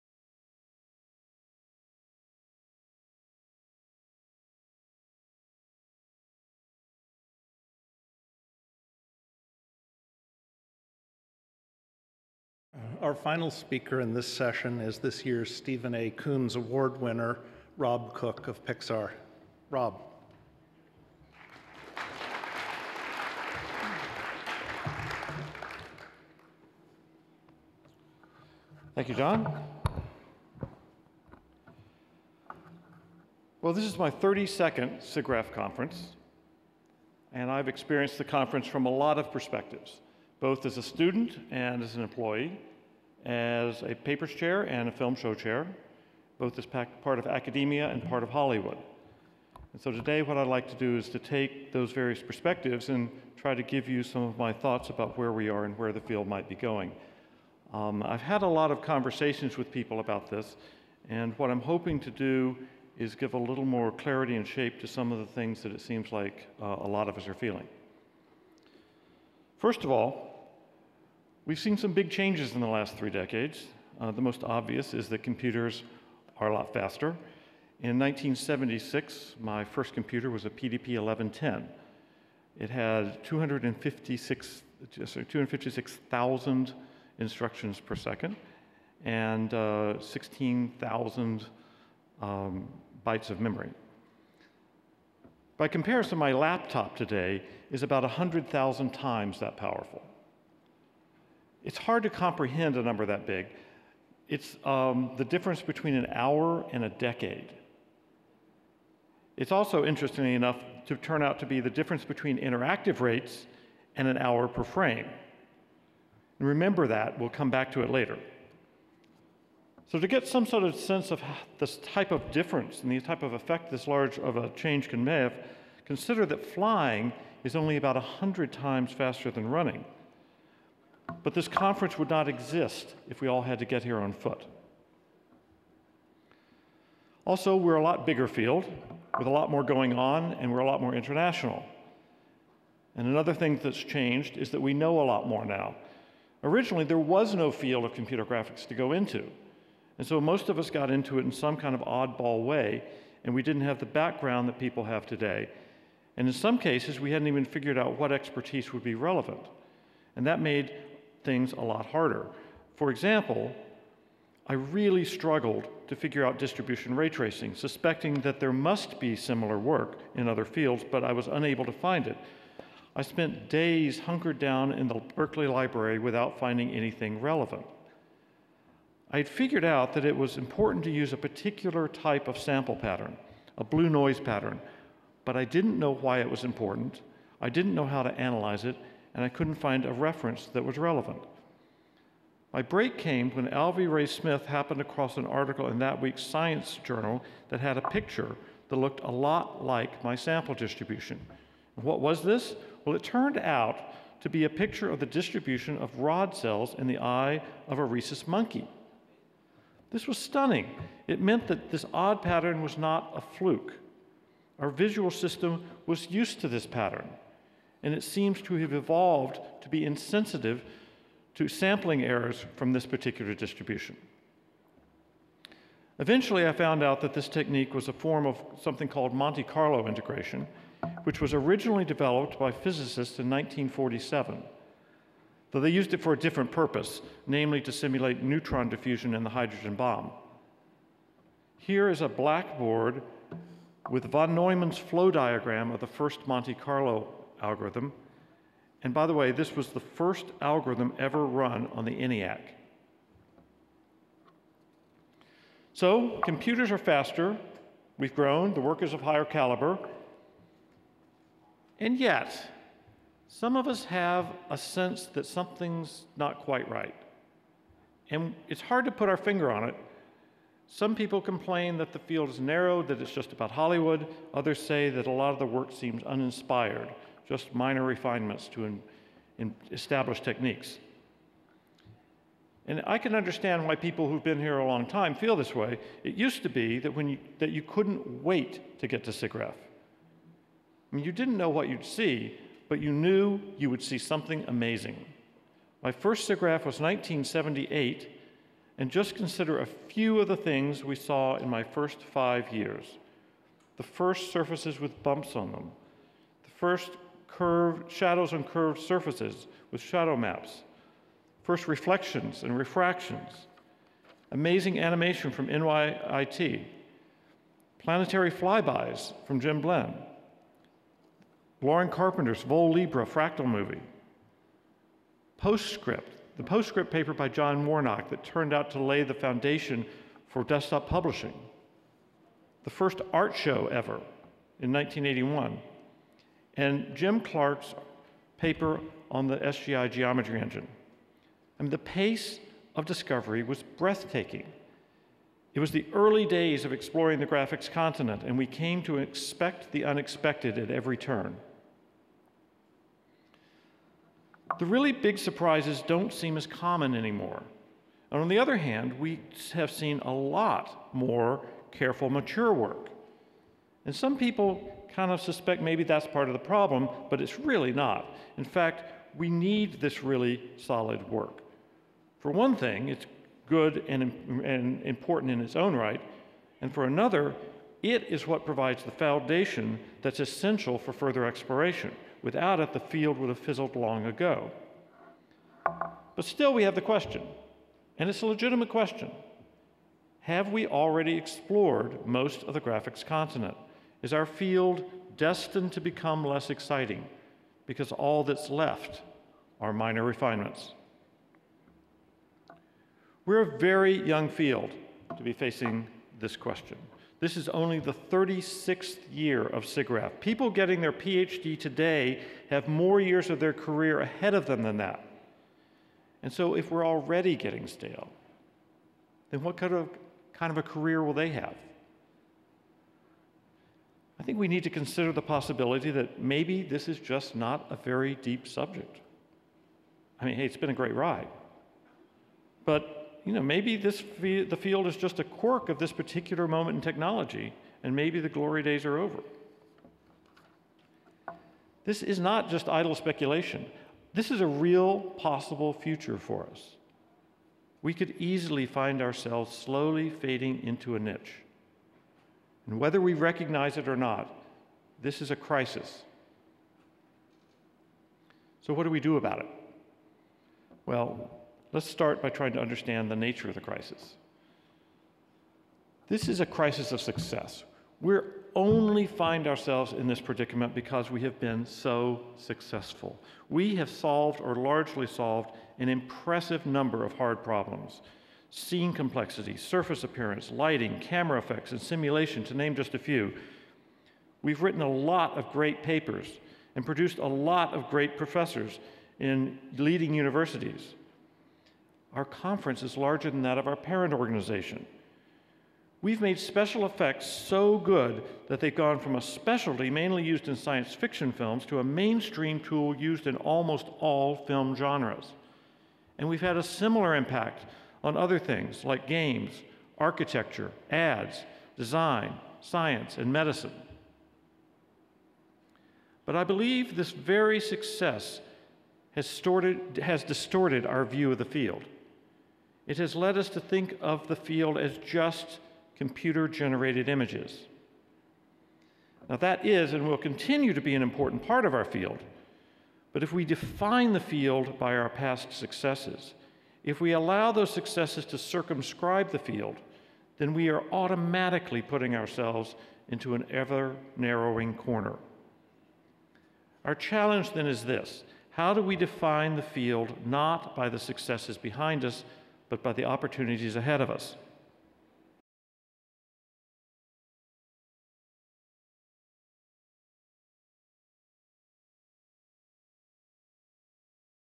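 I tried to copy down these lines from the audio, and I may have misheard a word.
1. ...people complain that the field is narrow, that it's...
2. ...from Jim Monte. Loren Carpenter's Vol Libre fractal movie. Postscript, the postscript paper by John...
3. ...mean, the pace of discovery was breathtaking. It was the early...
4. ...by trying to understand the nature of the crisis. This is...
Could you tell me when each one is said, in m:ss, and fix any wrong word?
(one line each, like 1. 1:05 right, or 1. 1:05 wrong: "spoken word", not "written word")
1. 4:30 right
2. 5:19 wrong: "Blinn", not "Monte"
3. 5:41 right
4. 7:42 right.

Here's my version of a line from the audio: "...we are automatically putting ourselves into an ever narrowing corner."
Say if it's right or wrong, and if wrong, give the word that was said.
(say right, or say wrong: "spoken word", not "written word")
right.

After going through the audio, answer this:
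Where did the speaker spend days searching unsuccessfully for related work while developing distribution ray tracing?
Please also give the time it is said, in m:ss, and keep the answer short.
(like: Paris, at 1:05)
Berkeley Library, at 2:55.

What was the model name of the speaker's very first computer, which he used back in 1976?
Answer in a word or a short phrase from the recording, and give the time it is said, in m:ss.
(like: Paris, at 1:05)
PDP 1110, at 1:20.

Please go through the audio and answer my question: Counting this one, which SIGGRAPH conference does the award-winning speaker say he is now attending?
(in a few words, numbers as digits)
32nd.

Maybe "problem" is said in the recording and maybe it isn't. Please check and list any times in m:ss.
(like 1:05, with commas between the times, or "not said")
6:06, 7:57.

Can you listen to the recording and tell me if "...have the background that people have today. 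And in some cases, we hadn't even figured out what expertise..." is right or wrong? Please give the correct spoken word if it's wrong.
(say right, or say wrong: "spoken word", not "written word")
right.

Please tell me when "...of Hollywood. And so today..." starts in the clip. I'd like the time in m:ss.
0:48.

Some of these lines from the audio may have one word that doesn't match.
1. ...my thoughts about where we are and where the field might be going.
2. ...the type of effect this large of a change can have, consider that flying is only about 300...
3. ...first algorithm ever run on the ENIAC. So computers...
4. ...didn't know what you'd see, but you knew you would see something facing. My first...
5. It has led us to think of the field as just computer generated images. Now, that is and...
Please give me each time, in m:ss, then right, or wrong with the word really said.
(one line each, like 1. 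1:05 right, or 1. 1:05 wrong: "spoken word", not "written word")
1. 0:54 right
2. 2:02 wrong: "100", not "300"
3. 4:09 right
4. 4:51 wrong: "amazing", not "facing"
5. 8:42 right.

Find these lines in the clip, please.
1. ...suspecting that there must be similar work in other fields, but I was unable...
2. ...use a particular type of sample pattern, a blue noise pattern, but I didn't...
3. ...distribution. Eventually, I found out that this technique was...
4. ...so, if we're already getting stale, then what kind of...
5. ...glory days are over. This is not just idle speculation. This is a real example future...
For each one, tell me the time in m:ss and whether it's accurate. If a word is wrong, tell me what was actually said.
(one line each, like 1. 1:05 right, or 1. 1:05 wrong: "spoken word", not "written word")
1. 2:47 right
2. 3:00 right
3. 3:43 right
4. 6:56 right
5. 7:18 wrong: "possible", not "example".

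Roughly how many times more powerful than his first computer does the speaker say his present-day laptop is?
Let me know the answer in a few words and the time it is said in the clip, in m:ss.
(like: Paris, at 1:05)
100,000, at 1:38.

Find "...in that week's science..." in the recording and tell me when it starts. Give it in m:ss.
3:15.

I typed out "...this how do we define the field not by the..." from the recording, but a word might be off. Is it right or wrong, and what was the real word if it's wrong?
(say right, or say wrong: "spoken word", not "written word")
right.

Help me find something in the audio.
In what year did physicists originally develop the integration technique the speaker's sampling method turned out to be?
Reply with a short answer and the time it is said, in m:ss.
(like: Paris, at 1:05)
1947, at 3:53.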